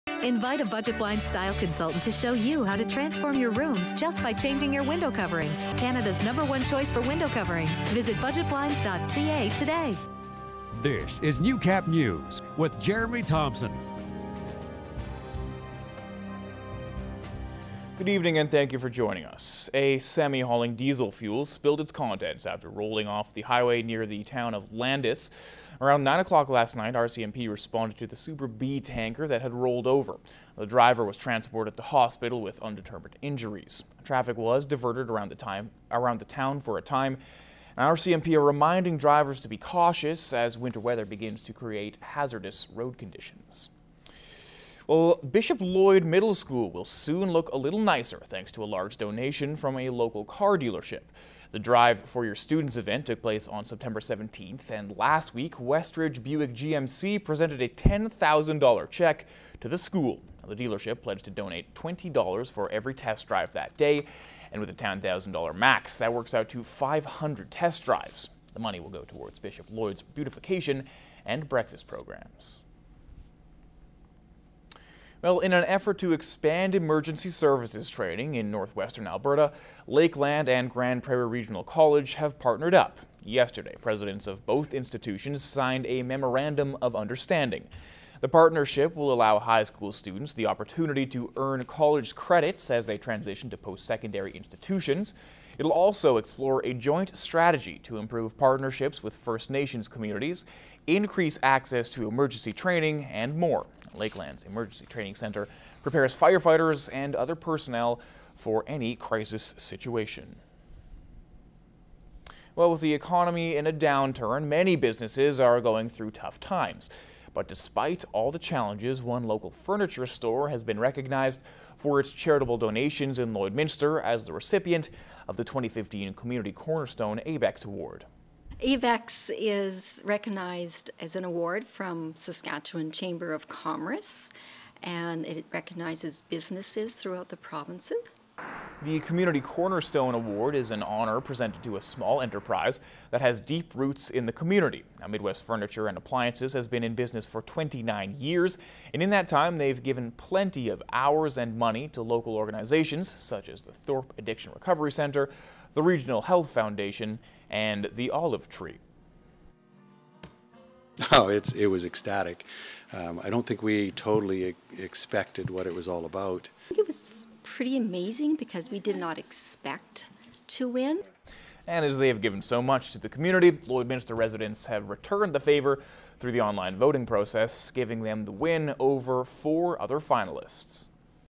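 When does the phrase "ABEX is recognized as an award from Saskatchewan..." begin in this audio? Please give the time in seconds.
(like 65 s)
128 s.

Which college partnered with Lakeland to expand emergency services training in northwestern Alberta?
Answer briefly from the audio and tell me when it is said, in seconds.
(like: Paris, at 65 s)
Grande Prairie Regional College, at 80 s.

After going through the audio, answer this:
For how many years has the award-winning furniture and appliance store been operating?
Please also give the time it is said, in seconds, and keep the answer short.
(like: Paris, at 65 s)
29 years, at 147 s.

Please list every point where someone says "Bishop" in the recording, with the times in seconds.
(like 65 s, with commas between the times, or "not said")
45 s, 69 s.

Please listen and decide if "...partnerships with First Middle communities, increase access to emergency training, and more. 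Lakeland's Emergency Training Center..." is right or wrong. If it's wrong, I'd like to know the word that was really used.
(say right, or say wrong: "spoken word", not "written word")
wrong: "Nations", not "Middle".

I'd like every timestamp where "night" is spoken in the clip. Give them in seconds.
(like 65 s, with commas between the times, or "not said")
26 s.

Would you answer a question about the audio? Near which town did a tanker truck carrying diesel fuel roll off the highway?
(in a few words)
Landis.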